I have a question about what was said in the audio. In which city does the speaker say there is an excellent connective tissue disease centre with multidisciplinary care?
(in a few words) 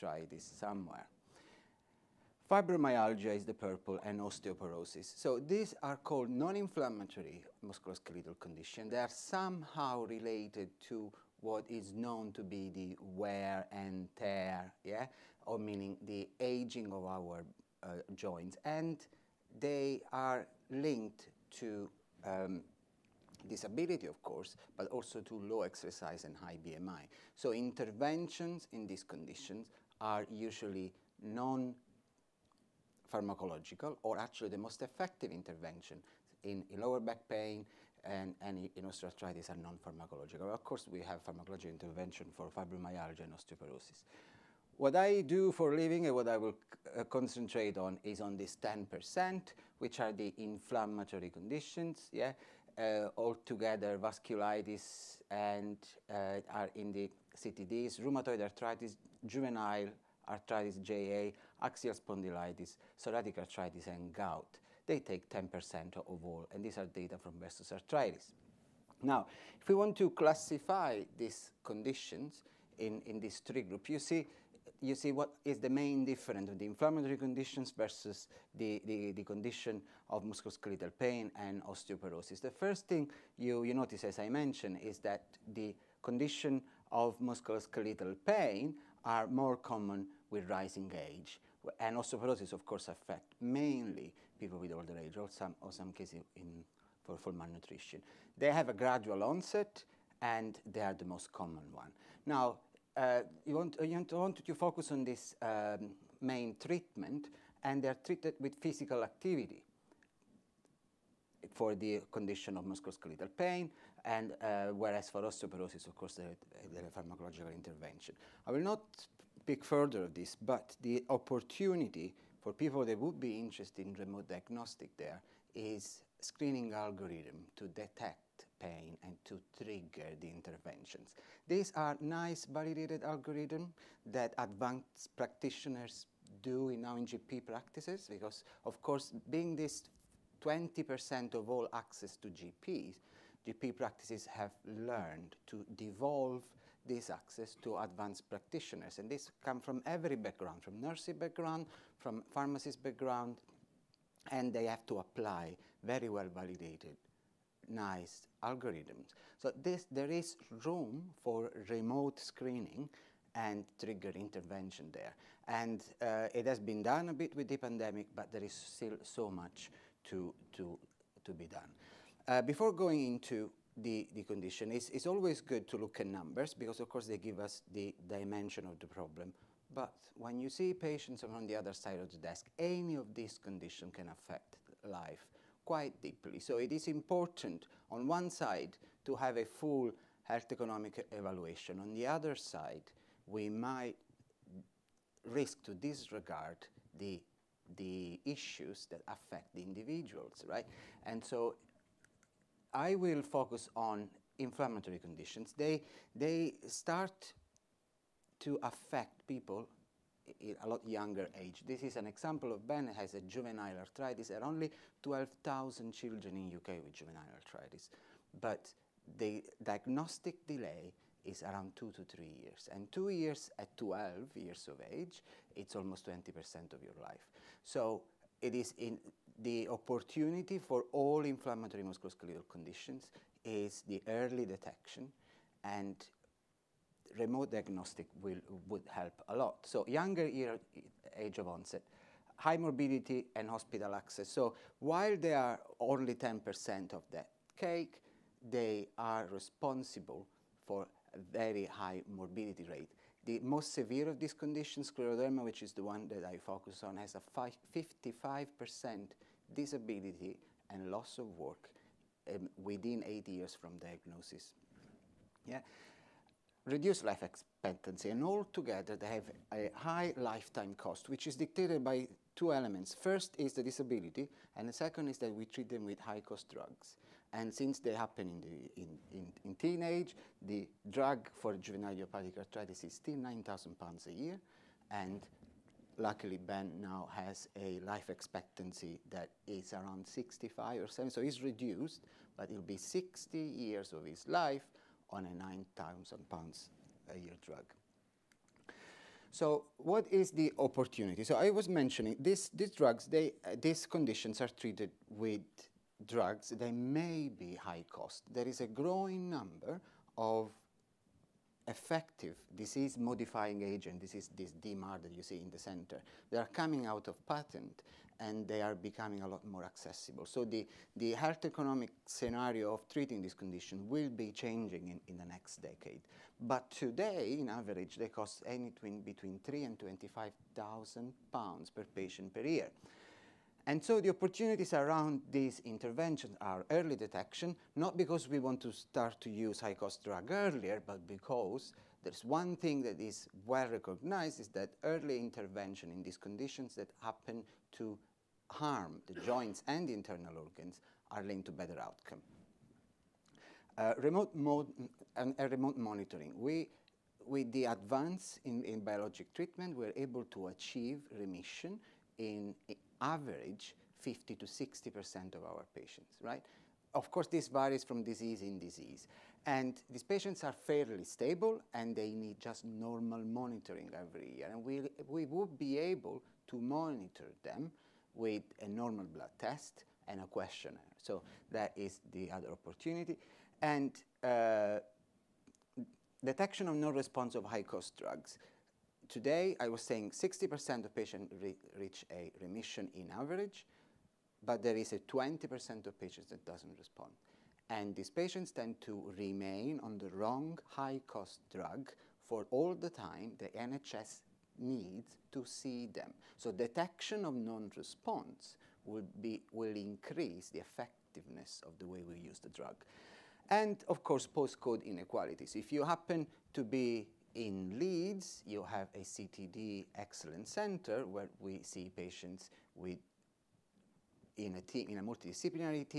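Leeds.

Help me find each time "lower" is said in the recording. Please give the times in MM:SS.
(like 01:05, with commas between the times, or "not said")
00:36.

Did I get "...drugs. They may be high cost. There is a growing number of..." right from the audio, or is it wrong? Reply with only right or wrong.
right.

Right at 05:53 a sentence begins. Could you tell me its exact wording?
Uh, remote uh, and uh, remote monitoring.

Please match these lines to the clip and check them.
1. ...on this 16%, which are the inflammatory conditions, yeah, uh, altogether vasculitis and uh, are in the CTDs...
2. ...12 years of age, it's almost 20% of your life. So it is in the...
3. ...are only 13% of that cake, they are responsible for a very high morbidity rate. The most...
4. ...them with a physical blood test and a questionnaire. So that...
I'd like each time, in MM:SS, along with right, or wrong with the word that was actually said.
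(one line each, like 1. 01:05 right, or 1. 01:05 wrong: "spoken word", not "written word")
1. 00:48 wrong: "10", not "16"
2. 03:43 right
3. 04:05 wrong: "10", not "13"
4. 06:17 wrong: "normal", not "physical".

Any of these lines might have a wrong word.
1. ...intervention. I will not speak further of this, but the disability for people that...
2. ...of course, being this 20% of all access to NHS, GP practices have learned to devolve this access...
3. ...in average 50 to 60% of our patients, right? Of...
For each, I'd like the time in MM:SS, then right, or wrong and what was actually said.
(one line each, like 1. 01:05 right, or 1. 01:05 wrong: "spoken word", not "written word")
1. 01:57 wrong: "opportunity", not "disability"
2. 02:18 wrong: "GPs", not "NHS"
3. 06:02 right.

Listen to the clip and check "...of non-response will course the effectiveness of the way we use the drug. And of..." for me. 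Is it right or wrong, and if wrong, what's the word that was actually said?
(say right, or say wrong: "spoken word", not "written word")
wrong: "increase", not "course".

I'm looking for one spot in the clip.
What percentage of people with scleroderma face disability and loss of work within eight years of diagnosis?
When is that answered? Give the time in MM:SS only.
04:17.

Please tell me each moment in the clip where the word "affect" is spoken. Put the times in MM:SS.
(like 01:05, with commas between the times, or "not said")
01:32, 03:04, 03:19, 03:28.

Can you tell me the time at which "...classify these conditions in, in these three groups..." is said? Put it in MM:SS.
01:10.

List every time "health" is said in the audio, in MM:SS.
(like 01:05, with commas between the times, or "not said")
03:10, 05:21.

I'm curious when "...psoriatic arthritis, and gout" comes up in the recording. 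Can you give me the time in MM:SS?
01:02.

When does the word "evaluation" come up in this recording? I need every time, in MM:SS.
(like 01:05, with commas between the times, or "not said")
03:11.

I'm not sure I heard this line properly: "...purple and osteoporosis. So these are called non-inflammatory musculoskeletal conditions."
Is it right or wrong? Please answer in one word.
right.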